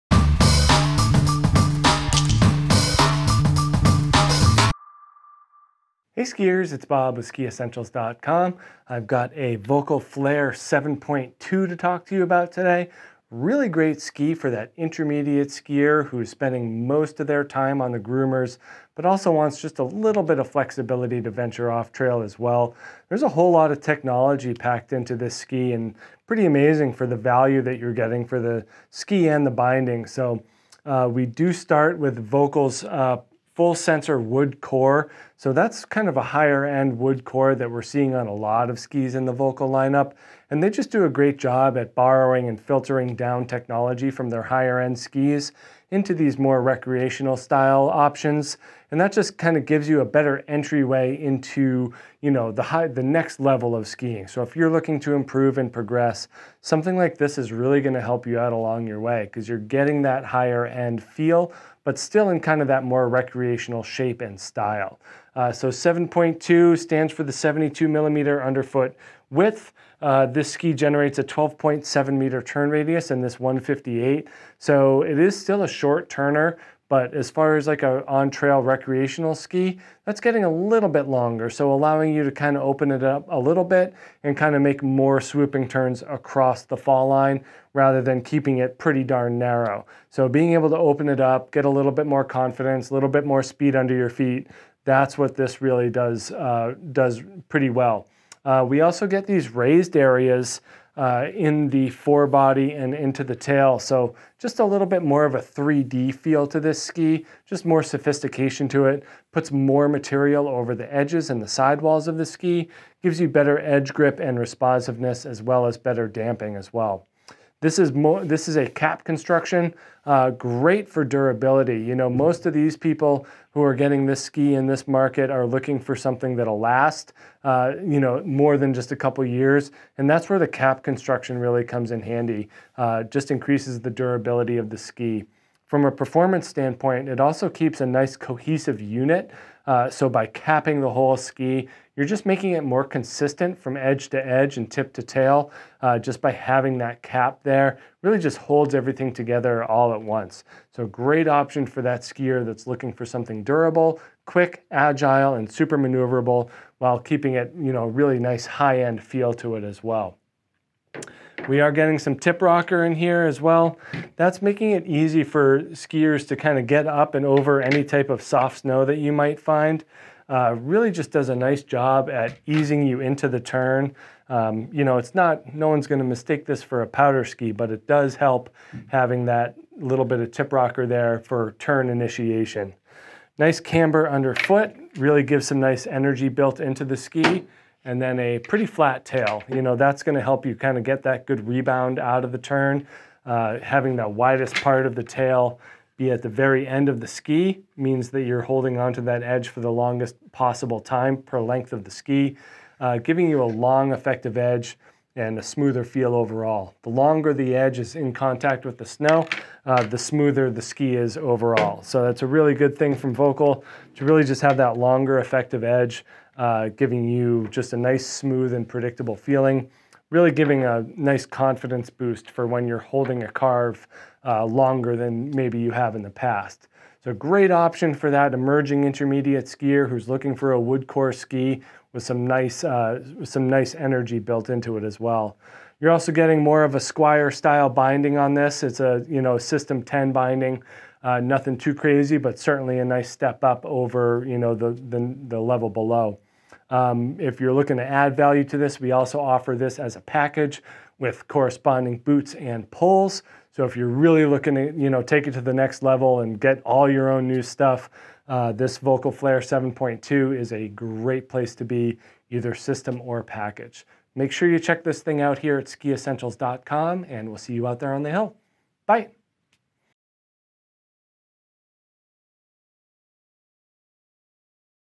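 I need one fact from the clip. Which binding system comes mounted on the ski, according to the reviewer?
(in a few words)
System 10.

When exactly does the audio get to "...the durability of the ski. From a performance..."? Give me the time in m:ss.
2:13.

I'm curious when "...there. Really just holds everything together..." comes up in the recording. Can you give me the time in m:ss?
2:27.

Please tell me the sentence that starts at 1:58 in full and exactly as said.
This is a cap construction, uh, great for durability.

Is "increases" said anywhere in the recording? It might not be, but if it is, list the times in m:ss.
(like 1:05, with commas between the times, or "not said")
2:13.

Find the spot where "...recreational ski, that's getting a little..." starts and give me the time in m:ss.
1:18.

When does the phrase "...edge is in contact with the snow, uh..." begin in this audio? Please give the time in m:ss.
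3:27.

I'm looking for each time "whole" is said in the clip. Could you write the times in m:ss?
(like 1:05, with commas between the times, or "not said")
0:23, 2:20.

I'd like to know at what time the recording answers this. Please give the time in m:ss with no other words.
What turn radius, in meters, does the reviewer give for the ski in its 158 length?
1:11.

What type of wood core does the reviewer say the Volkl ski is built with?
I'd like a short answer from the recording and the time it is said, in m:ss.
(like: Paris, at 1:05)
full sensor wood core, at 0:33.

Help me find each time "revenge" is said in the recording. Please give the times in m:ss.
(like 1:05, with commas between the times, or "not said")
not said.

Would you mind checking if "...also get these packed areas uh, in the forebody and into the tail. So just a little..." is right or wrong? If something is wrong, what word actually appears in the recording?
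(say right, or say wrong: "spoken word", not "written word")
wrong: "raised", not "packed".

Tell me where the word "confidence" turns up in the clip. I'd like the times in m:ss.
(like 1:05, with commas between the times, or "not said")
1:32, 3:41.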